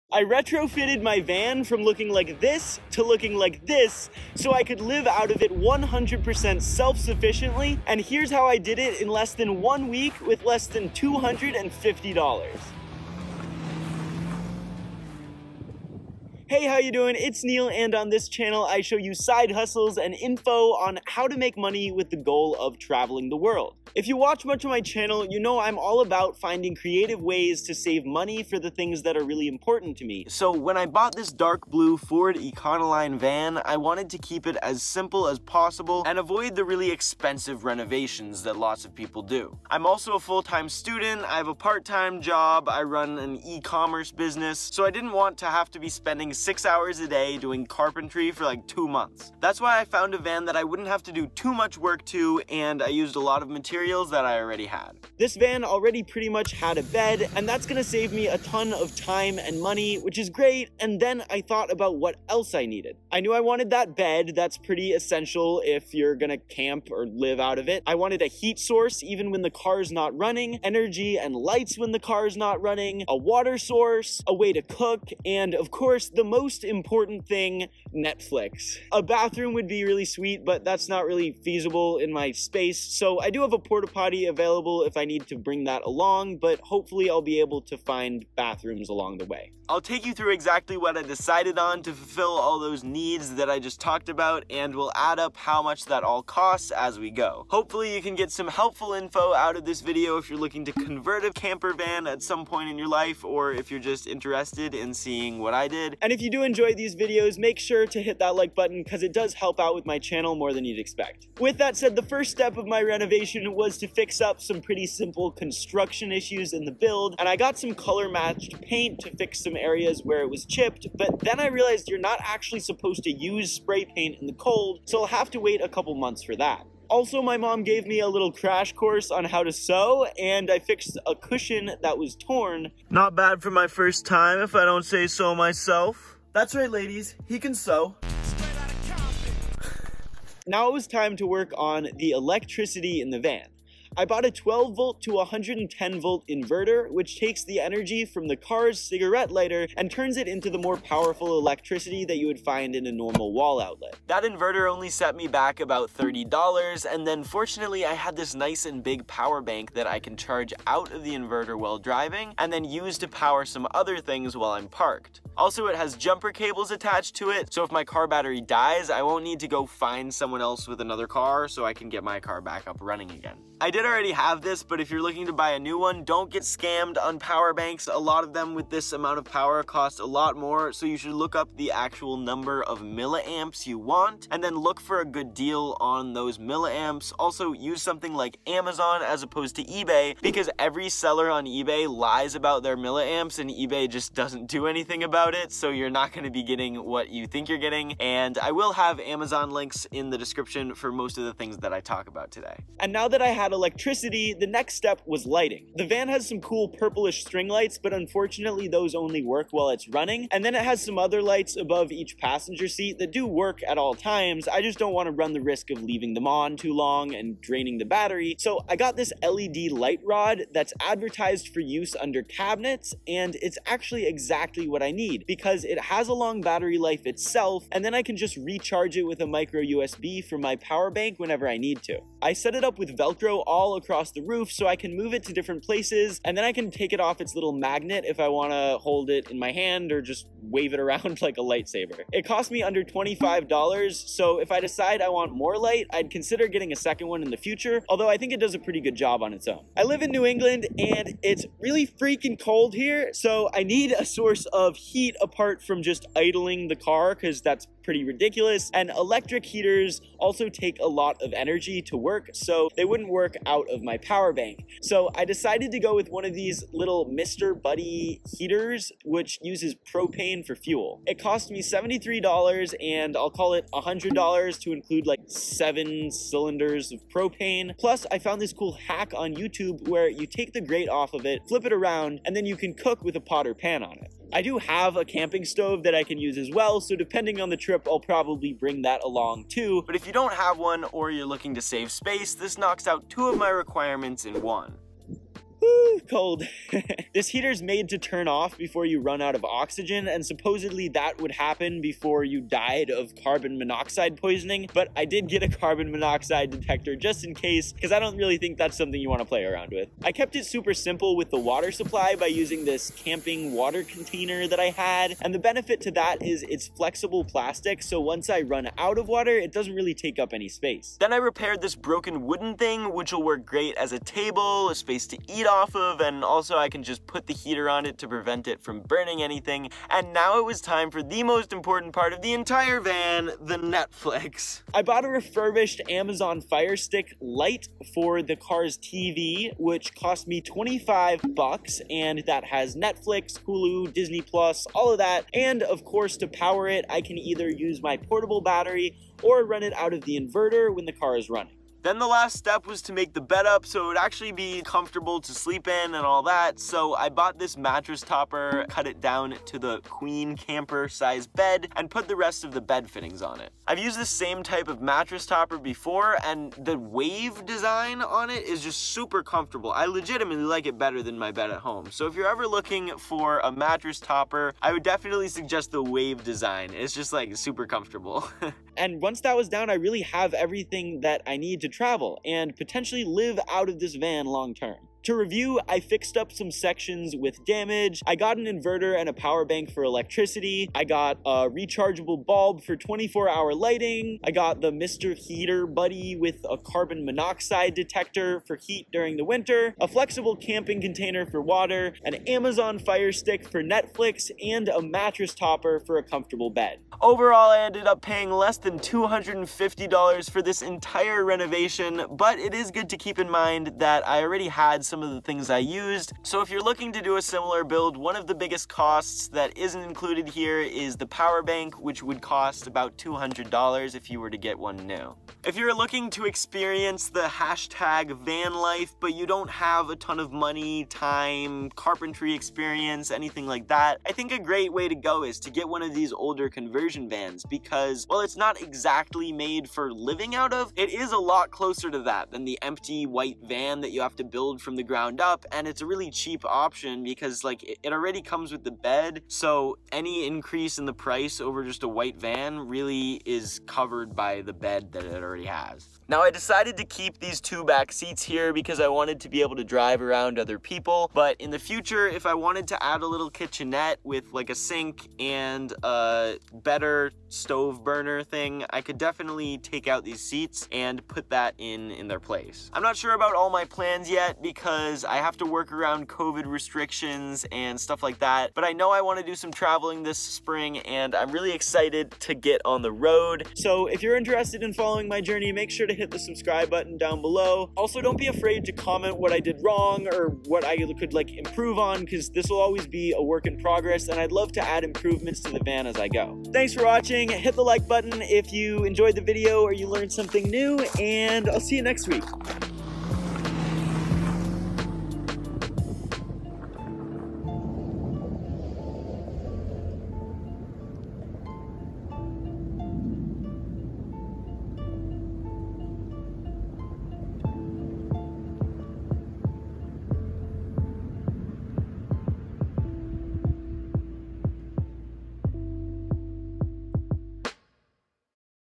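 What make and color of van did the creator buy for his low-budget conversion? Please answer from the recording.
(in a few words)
Dark blue Ford Econoline.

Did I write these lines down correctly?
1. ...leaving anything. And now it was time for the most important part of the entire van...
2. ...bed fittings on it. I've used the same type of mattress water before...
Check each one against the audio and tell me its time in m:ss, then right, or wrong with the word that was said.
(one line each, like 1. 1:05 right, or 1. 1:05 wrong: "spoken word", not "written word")
1. 5:28 wrong: "burning", not "leaving"
2. 6:02 wrong: "topper", not "water".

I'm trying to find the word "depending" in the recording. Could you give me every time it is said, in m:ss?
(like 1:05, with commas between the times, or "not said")
4:46.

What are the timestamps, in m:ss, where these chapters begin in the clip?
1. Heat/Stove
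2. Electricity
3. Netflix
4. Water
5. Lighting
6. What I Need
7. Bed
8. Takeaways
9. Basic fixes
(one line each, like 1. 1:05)
1. 4:09
2. 2:20
3. 5:30
4. 5:09
5. 3:22
6. 1:00
7. 5:51
8. 7:48
9. 1:45.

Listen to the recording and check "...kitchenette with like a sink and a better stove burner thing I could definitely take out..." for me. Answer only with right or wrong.
right.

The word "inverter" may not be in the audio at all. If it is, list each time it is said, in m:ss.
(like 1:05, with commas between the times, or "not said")
2:26, 2:34, 2:41, 5:50, 6:28.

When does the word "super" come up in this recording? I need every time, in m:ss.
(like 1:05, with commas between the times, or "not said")
5:10, 6:08, 6:17.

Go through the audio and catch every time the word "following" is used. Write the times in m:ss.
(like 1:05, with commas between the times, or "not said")
8:04.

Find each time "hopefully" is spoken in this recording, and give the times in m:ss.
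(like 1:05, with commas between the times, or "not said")
1:26, 1:37.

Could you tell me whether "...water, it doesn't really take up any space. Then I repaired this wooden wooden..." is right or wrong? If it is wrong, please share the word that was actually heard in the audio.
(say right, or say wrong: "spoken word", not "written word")
wrong: "broken", not "wooden".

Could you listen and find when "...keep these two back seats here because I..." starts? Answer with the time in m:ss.
7:36.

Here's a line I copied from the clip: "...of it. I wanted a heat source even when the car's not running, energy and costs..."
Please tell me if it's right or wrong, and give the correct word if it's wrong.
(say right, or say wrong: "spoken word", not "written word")
wrong: "lights", not "costs".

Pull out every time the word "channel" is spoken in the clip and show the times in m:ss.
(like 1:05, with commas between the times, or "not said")
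0:18, 0:24, 1:49.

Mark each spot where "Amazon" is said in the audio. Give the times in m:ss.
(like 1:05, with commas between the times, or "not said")
3:08, 3:18, 5:35, 6:42.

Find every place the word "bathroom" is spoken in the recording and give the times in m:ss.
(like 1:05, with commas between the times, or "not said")
1:19, 1:28.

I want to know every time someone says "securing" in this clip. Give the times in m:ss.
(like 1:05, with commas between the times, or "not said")
not said.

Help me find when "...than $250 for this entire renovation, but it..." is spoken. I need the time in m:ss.
6:48.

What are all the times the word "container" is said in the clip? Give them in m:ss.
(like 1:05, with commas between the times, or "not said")
5:13, 6:40.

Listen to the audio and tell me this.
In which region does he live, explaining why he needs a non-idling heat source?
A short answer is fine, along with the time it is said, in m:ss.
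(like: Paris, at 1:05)
New England, at 4:10.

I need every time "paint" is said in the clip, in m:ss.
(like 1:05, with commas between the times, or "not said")
1:58, 2:03.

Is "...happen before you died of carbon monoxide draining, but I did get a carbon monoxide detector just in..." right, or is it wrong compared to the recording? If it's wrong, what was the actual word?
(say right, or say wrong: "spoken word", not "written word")
wrong: "poisoning", not "draining".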